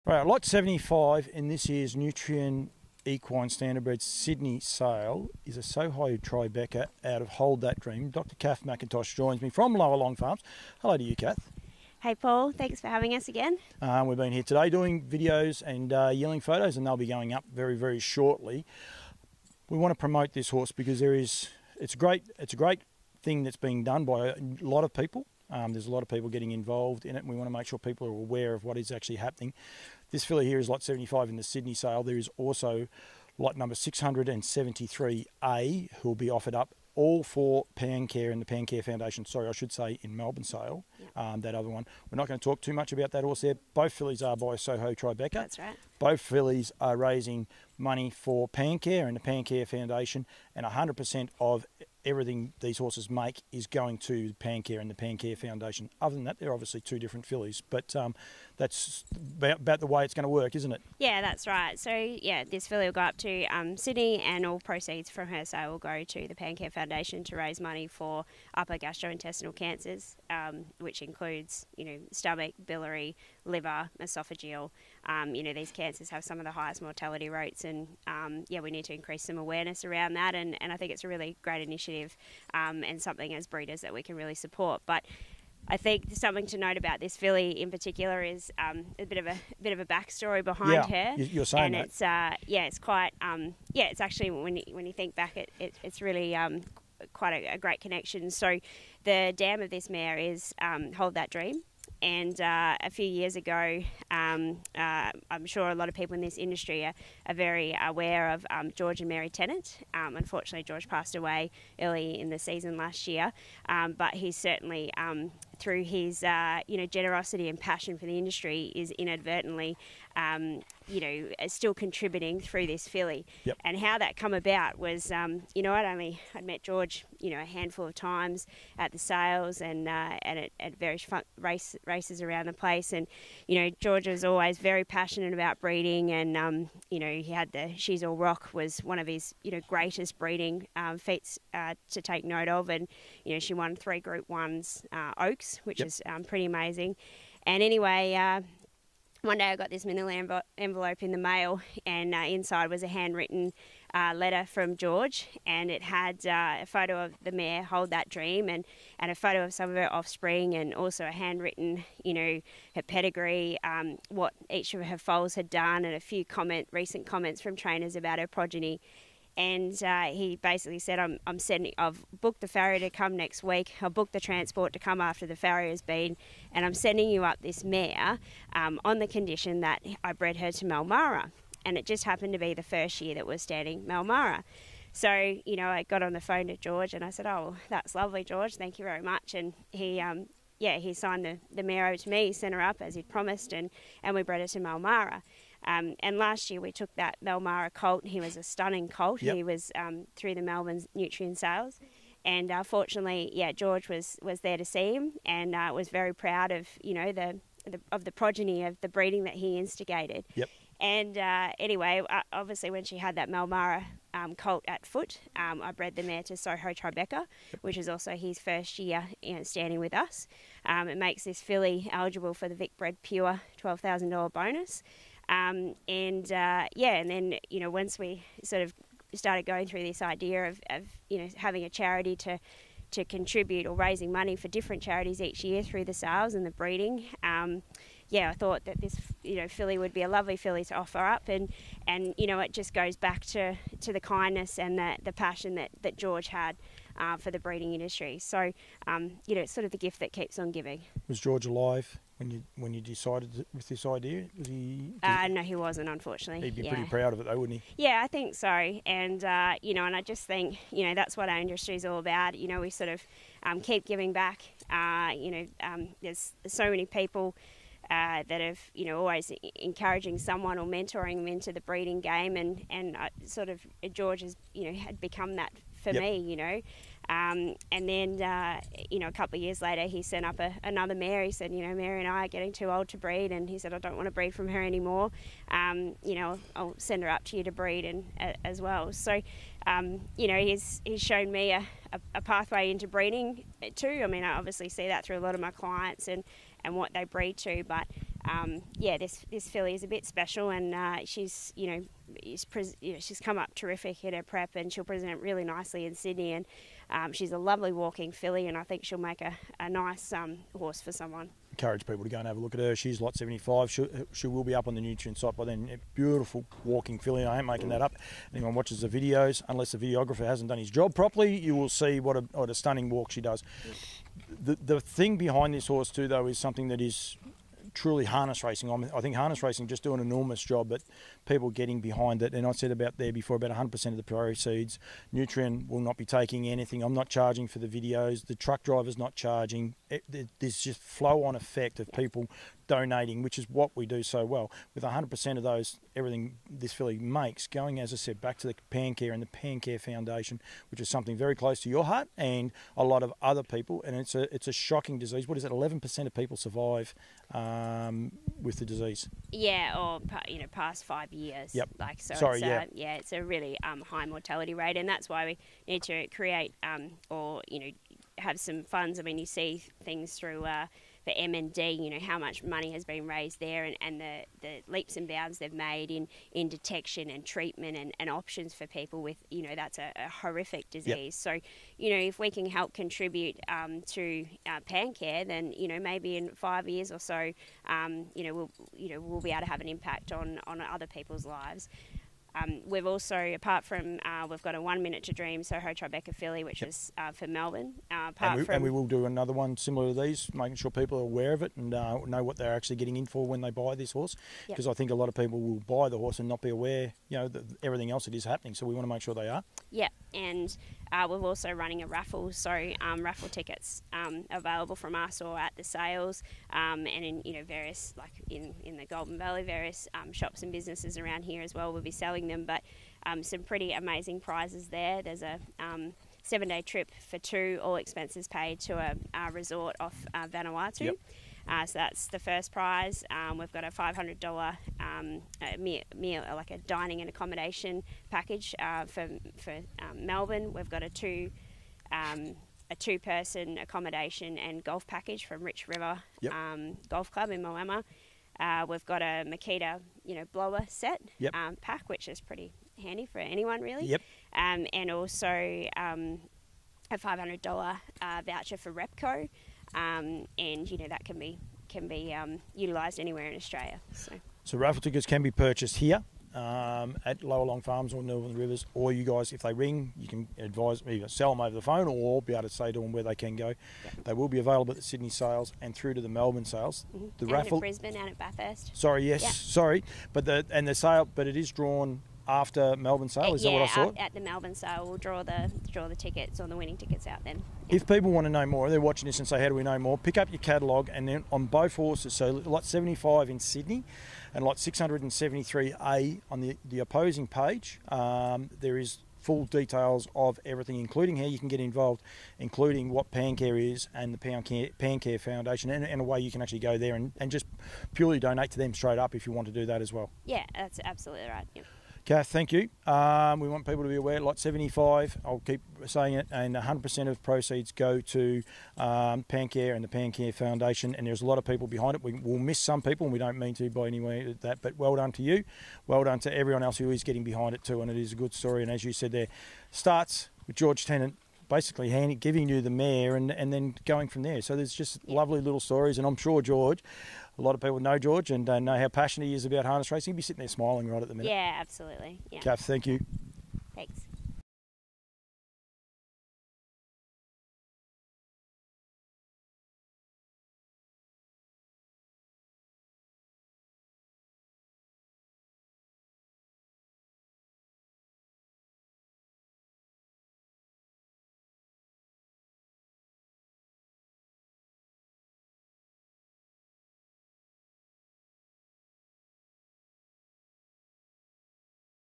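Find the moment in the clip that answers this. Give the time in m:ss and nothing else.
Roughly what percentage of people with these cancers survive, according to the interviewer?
5:55.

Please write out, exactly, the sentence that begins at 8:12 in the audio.
So lot 75 in Sydney, and lot 673A on the the opposing page.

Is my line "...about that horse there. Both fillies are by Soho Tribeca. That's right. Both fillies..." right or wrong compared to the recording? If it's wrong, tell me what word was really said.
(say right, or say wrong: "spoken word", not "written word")
right.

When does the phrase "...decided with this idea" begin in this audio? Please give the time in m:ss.
4:12.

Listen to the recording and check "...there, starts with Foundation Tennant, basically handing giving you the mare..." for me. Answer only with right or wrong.
wrong.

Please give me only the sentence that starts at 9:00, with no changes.
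He'd be sitting there smiling right at the minute.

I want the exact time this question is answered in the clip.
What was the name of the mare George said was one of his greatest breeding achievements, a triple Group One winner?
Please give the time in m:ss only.
2:17.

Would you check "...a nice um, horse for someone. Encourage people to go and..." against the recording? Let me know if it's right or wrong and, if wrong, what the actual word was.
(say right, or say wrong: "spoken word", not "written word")
right.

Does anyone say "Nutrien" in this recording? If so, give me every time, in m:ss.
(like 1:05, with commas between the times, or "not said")
0:01, 3:20, 5:14, 5:35.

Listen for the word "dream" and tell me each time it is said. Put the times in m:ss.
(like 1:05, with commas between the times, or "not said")
0:07, 1:41, 2:38, 6:35.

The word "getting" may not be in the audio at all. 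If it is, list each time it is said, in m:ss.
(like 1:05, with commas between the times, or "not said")
0:26, 4:42, 5:31, 6:42, 8:47.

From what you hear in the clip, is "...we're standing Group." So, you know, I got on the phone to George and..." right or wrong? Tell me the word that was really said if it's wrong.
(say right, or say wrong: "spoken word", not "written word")
wrong: "Malmara", not "Group".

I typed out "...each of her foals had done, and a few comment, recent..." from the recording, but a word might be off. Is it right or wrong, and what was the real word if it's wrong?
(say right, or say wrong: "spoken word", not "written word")
right.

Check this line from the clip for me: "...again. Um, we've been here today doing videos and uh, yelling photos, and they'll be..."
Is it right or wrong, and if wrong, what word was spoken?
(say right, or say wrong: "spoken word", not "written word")
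right.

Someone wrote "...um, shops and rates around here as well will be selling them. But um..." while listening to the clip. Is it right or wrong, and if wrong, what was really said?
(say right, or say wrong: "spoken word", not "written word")
wrong: "businesses", not "rates".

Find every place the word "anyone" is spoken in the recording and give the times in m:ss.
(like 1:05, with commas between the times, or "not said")
5:18, 7:33.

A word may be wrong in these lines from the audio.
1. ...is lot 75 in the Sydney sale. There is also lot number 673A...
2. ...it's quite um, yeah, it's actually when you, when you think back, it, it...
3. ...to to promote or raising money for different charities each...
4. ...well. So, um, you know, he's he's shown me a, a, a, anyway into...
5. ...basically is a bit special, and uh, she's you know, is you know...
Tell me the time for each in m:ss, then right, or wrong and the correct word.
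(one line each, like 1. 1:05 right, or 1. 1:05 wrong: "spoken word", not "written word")
1. 0:30 right
2. 1:32 right
3. 3:52 wrong: "contribute", not "promote"
4. 4:48 wrong: "pathway", not "anyway"
5. 4:59 wrong: "filly", not "basically".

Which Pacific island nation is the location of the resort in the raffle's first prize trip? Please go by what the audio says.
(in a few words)
Vanuatu.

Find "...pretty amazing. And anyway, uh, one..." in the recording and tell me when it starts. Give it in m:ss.
2:26.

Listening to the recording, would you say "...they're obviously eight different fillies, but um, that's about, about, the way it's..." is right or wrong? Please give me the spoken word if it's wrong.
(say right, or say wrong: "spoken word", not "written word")
wrong: "two", not "eight".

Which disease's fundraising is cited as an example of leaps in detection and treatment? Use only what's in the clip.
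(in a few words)
MND.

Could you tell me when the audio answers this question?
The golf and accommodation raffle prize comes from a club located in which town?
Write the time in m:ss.
7:27.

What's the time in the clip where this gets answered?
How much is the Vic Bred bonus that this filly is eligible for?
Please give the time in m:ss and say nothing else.
3:43.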